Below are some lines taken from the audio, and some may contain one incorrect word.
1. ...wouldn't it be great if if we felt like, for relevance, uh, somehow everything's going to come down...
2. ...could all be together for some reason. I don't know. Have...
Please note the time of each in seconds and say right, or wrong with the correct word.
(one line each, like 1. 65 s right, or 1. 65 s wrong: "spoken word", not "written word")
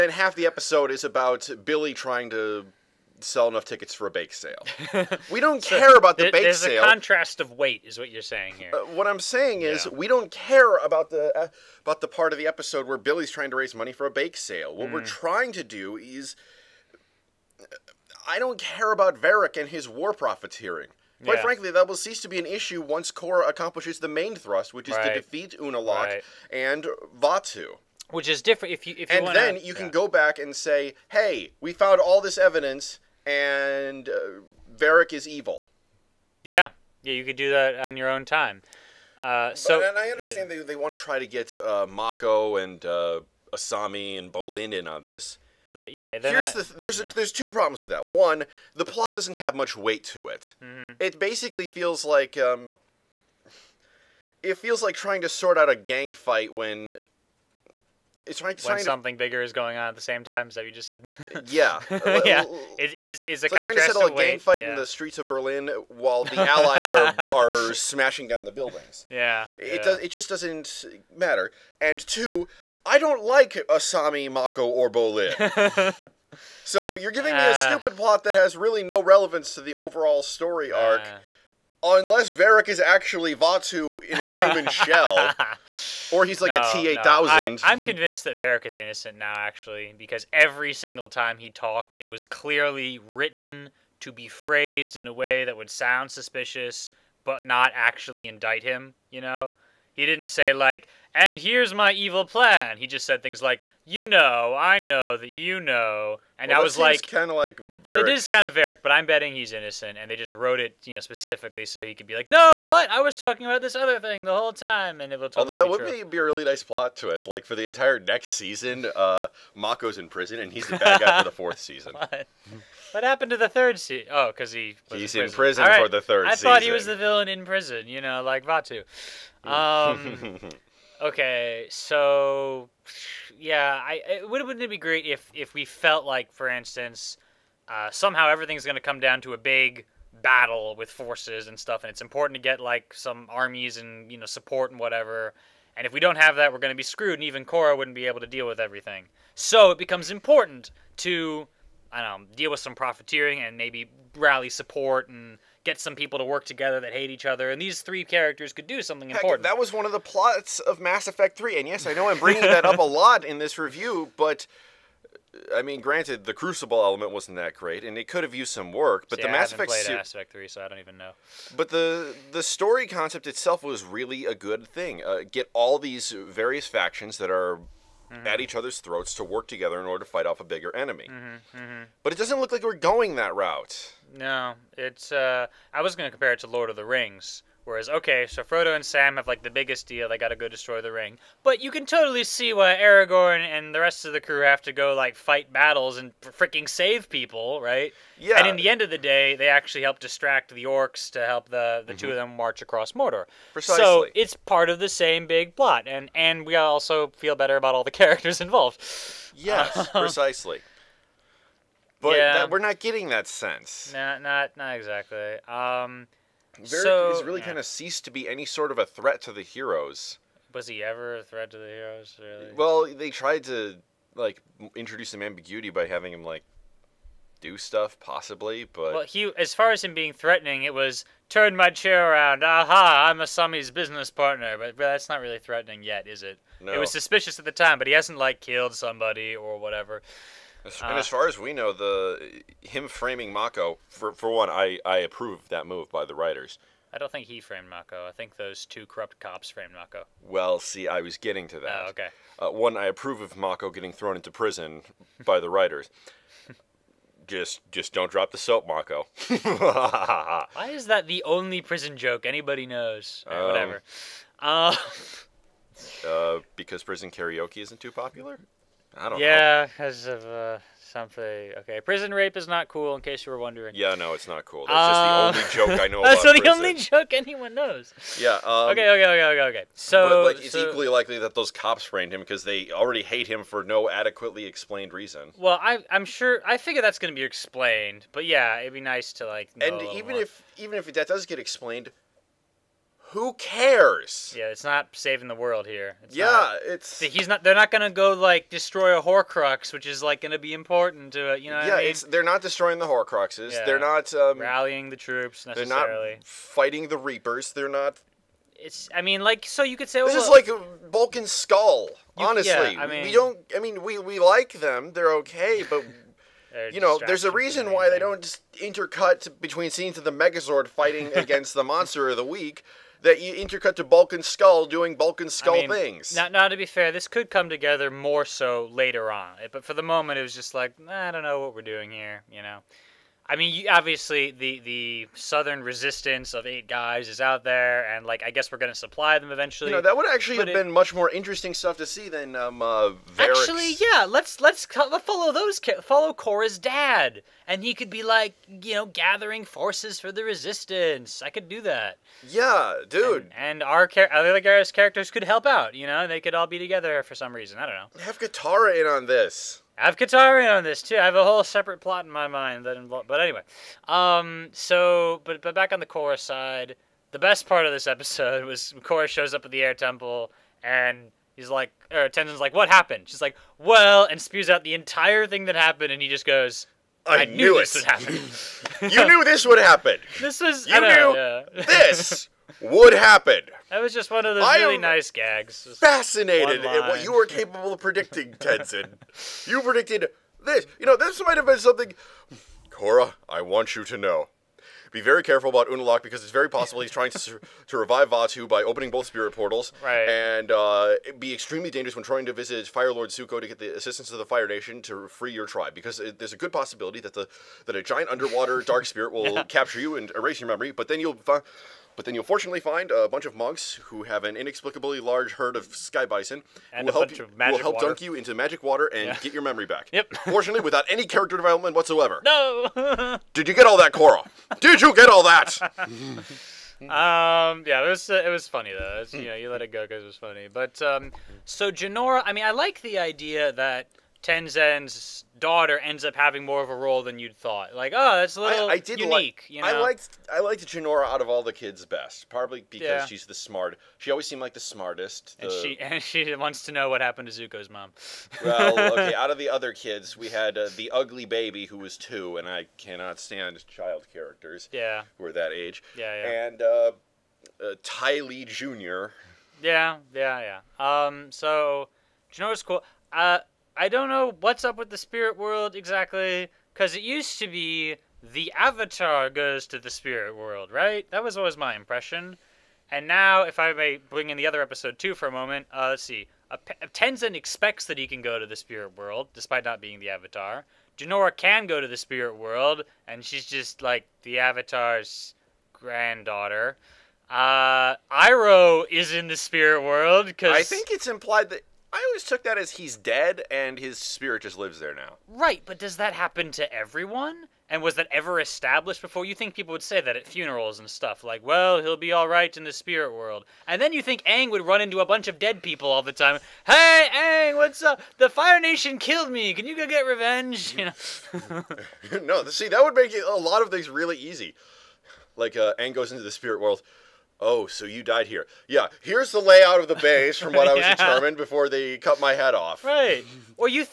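1. 134 s wrong: "instance", not "relevance"
2. 356 s right.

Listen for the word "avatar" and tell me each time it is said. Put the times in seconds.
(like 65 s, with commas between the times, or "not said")
468 s, 480 s, 484 s.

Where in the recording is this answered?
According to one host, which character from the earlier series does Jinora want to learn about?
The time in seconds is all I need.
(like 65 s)
447 s.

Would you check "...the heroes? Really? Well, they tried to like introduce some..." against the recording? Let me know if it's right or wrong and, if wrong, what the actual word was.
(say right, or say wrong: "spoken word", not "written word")
right.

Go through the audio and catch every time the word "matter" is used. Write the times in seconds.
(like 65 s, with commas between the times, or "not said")
71 s.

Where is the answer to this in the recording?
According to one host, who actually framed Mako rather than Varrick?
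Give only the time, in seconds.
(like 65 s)
248 s.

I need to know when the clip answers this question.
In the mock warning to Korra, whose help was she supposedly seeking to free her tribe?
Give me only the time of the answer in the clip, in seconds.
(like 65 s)
402 s.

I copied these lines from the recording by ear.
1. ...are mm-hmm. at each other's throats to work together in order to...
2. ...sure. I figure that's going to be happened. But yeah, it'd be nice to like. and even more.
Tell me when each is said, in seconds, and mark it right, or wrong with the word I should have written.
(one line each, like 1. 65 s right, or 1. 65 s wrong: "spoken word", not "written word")
1. 177 s right
2. 286 s wrong: "explained", not "happened".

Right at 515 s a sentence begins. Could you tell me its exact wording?
Like, uh, Aang goes into the spirit world.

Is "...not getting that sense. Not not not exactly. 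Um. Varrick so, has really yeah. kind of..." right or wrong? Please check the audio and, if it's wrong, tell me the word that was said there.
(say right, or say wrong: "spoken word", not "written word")
right.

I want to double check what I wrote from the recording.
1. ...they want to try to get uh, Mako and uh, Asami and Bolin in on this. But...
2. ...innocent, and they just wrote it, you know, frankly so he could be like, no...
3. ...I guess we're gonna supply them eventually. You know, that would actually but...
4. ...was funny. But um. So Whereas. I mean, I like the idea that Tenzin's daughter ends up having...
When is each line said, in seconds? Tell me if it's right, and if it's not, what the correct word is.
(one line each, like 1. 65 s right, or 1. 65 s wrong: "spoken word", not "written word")
1. 40 s right
2. 109 s wrong: "specifically", not "frankly"
3. 338 s right
4. 430 s wrong: "Jinora", not "Whereas".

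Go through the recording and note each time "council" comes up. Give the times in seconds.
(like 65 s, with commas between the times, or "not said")
not said.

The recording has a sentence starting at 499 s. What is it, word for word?
You think people would say that at funerals and stuff, like, well, he'll be all right in the spirit world.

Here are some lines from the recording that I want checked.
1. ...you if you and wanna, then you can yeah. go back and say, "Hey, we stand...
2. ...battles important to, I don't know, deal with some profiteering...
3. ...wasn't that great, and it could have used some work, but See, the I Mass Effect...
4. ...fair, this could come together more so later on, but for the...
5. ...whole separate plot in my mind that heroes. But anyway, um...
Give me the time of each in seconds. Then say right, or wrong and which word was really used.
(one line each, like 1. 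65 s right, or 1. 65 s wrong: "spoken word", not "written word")
1. 28 s wrong: "found", not "stand"
2. 149 s wrong: "becomes", not "battles"
3. 167 s right
4. 326 s right
5. 361 s wrong: "involves", not "heroes".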